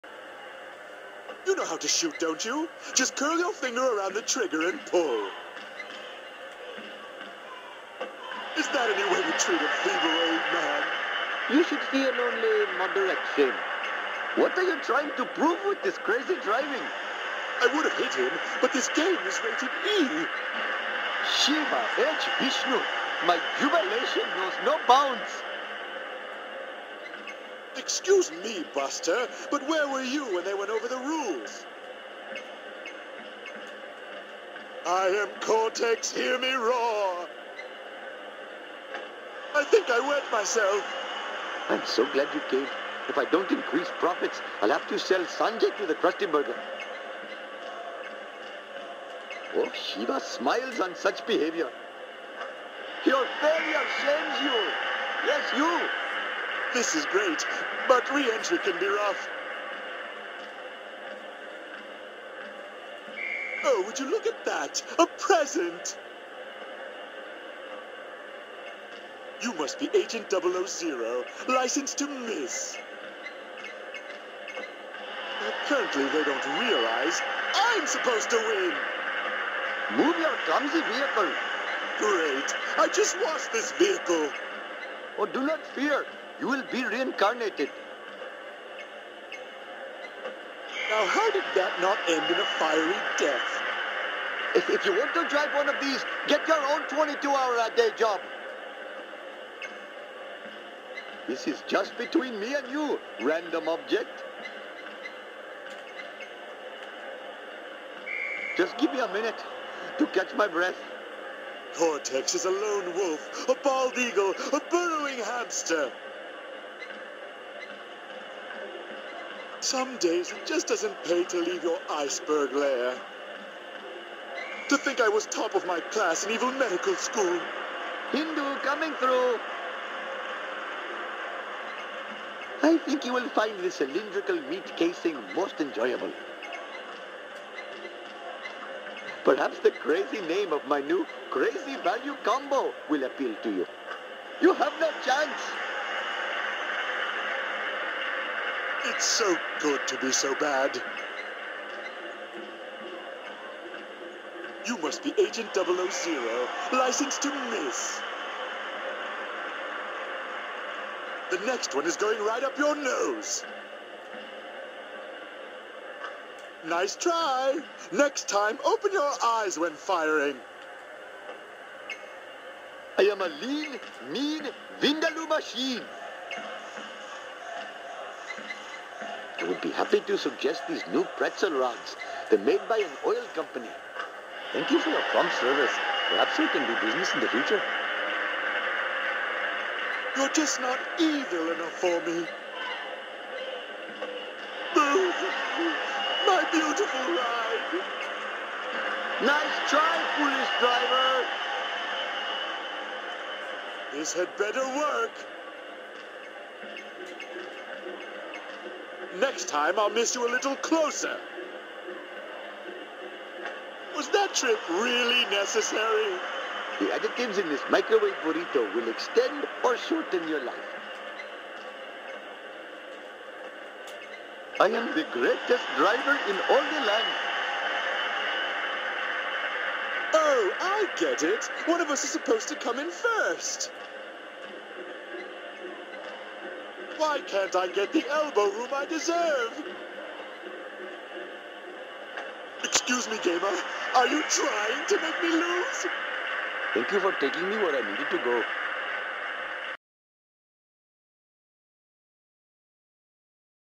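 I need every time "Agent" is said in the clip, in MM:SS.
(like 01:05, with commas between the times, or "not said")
01:09, 02:35.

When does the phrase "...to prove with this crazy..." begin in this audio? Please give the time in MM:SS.
00:15.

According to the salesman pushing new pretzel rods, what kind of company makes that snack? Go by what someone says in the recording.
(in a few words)
An oil company.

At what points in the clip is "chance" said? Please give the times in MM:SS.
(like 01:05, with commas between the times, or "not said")
02:25.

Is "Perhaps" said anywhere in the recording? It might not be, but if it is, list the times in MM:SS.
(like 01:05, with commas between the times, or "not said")
02:19, 03:06.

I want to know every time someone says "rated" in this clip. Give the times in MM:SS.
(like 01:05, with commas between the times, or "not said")
00:19.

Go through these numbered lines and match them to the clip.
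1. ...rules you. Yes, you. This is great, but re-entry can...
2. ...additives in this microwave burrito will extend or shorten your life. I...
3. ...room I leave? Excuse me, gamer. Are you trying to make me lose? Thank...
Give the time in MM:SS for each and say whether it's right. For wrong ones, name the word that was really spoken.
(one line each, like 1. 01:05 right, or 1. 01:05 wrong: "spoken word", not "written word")
1. 00:54 wrong: "shames", not "rules"
2. 03:36 right
3. 03:58 wrong: "deserve", not "leave".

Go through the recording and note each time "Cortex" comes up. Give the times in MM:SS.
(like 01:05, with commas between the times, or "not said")
00:35, 01:51.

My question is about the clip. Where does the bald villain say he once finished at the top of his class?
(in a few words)
Evil medical school.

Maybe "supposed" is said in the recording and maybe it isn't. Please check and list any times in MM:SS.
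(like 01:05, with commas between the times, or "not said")
01:17, 03:52.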